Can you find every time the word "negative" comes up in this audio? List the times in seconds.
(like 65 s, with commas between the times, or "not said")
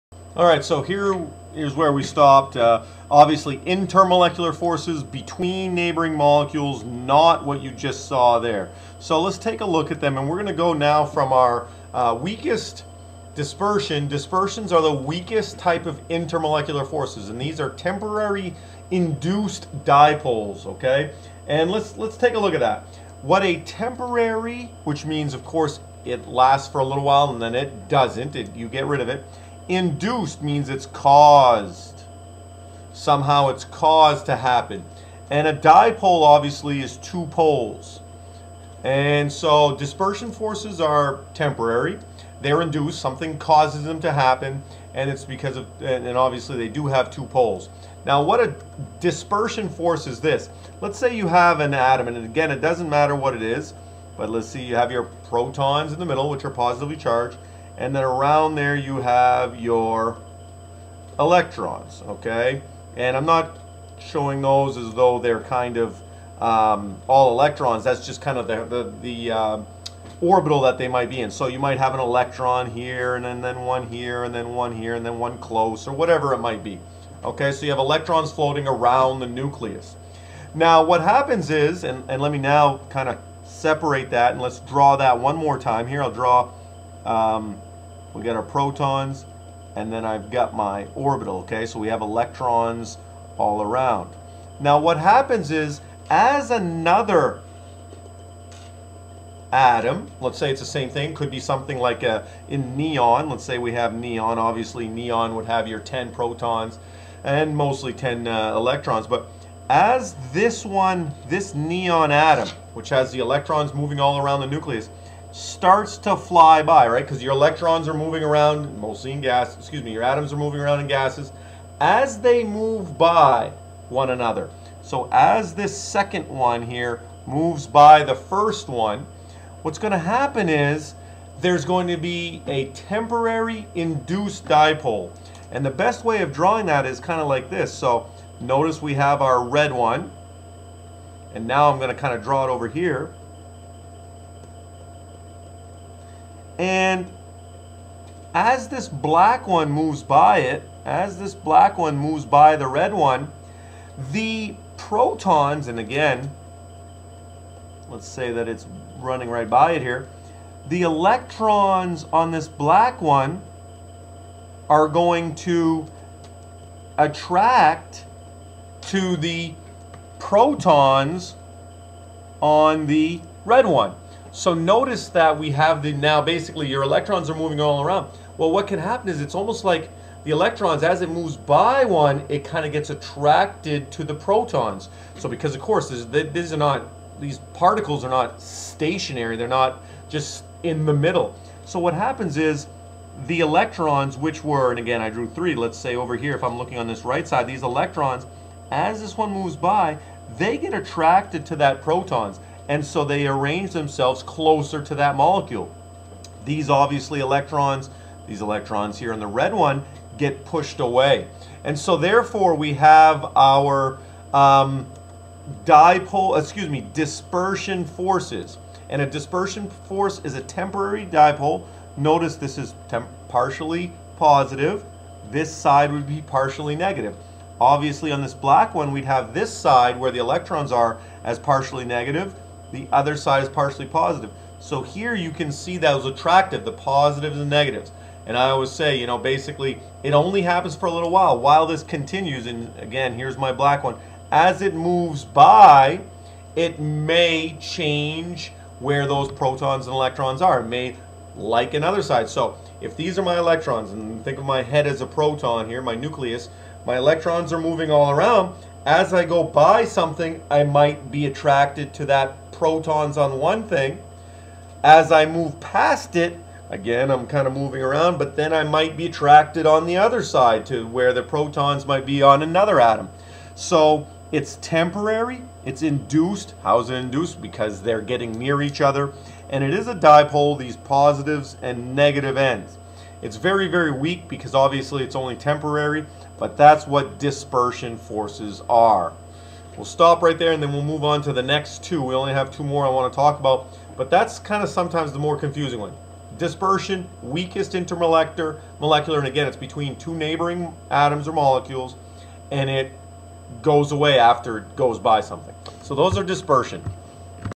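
226 s, 231 s, 237 s, 281 s.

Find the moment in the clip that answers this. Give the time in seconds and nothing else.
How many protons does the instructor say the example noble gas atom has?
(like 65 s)
105 s.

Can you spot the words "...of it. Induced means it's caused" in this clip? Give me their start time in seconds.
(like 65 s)
29 s.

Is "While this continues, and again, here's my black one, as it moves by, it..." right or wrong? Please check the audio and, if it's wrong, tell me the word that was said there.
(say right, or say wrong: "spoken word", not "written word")
right.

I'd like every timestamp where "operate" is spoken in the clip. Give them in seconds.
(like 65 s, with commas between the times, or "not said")
not said.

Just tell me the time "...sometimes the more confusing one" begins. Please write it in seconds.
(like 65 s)
294 s.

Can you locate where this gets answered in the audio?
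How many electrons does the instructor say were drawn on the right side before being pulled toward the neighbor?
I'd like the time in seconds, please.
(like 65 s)
195 s.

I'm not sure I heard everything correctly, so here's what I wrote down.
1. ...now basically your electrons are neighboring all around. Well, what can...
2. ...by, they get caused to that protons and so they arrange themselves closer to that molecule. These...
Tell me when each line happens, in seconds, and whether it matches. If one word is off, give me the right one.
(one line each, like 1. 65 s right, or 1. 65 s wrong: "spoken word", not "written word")
1. 175 s wrong: "moving", not "neighboring"
2. 199 s wrong: "attracted", not "caused".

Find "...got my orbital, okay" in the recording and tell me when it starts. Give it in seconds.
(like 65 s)
90 s.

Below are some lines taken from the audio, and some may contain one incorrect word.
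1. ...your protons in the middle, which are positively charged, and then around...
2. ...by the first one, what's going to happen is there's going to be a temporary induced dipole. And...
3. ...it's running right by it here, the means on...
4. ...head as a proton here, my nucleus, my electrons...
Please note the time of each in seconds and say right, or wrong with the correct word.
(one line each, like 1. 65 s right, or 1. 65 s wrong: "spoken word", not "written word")
1. 54 s right
2. 127 s right
3. 158 s wrong: "electrons", not "means"
4. 254 s right.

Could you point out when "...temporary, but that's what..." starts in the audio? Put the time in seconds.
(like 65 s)
285 s.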